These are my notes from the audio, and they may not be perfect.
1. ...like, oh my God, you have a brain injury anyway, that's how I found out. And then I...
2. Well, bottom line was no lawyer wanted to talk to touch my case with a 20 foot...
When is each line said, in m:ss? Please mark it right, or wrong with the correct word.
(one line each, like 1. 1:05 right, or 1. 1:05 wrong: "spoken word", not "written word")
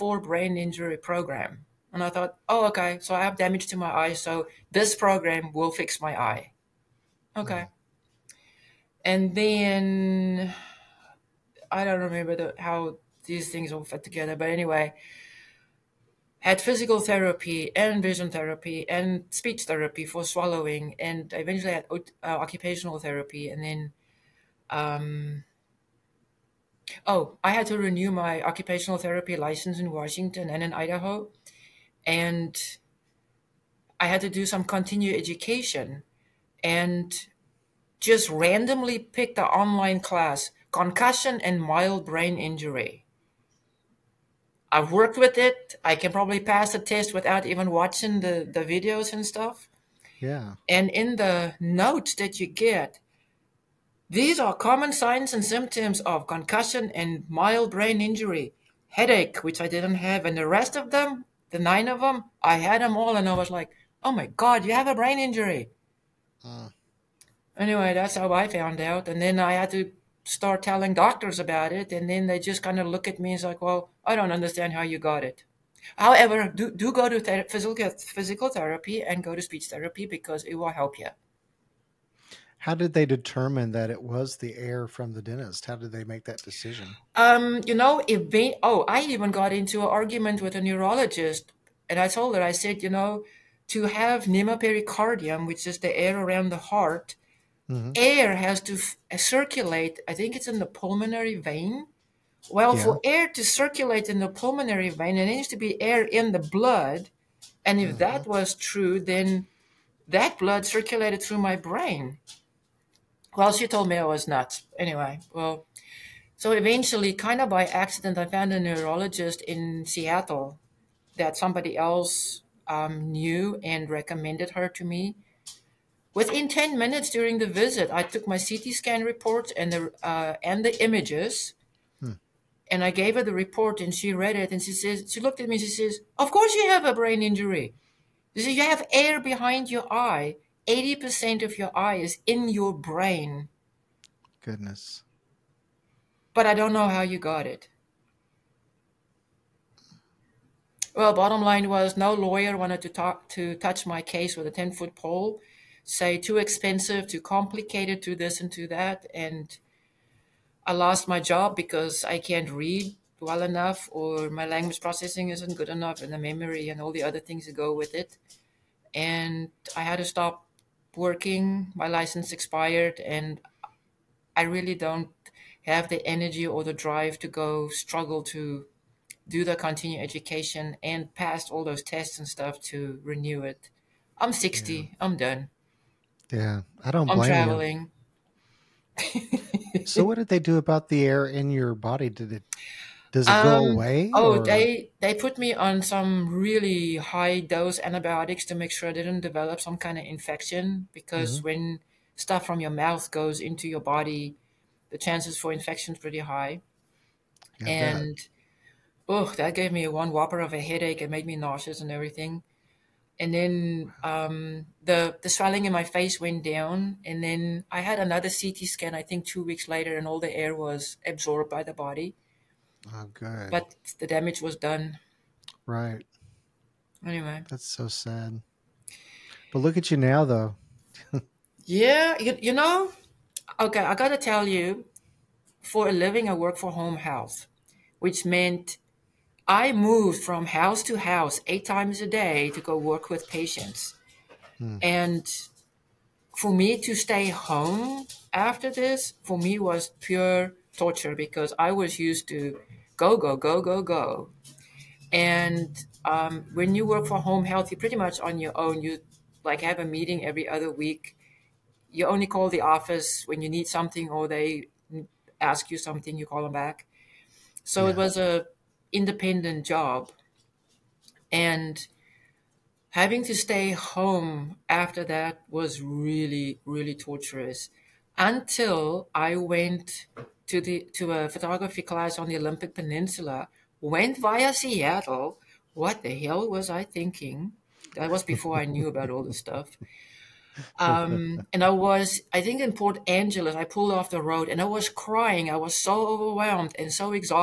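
1. 1:03 right
2. 2:30 wrong: "10", not "20".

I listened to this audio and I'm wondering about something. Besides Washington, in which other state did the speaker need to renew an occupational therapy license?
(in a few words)
Idaho.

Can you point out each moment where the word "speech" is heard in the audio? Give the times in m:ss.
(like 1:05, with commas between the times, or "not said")
0:19, 1:19.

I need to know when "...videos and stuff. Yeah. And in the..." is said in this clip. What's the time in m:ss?
0:48.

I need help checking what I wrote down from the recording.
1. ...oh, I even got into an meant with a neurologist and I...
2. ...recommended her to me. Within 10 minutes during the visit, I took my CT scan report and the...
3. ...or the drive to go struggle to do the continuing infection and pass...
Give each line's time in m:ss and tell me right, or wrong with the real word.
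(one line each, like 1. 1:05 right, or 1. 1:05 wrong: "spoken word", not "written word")
1. 1:28 wrong: "argument", not "meant"
2. 2:03 right
3. 2:56 wrong: "education", not "infection".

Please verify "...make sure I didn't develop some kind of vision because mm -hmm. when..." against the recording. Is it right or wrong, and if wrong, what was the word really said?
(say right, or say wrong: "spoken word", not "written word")
wrong: "infection", not "vision".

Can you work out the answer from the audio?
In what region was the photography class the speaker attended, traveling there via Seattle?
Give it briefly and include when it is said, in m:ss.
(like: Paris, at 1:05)
Olympic Peninsula, at 4:42.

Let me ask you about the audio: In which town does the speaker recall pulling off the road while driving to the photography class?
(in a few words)
Port Angeles.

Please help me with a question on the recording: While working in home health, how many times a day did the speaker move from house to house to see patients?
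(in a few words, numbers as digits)
8.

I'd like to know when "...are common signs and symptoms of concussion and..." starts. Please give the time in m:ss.
0:54.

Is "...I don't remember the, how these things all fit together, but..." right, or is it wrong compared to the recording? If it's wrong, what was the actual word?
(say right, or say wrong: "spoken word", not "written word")
right.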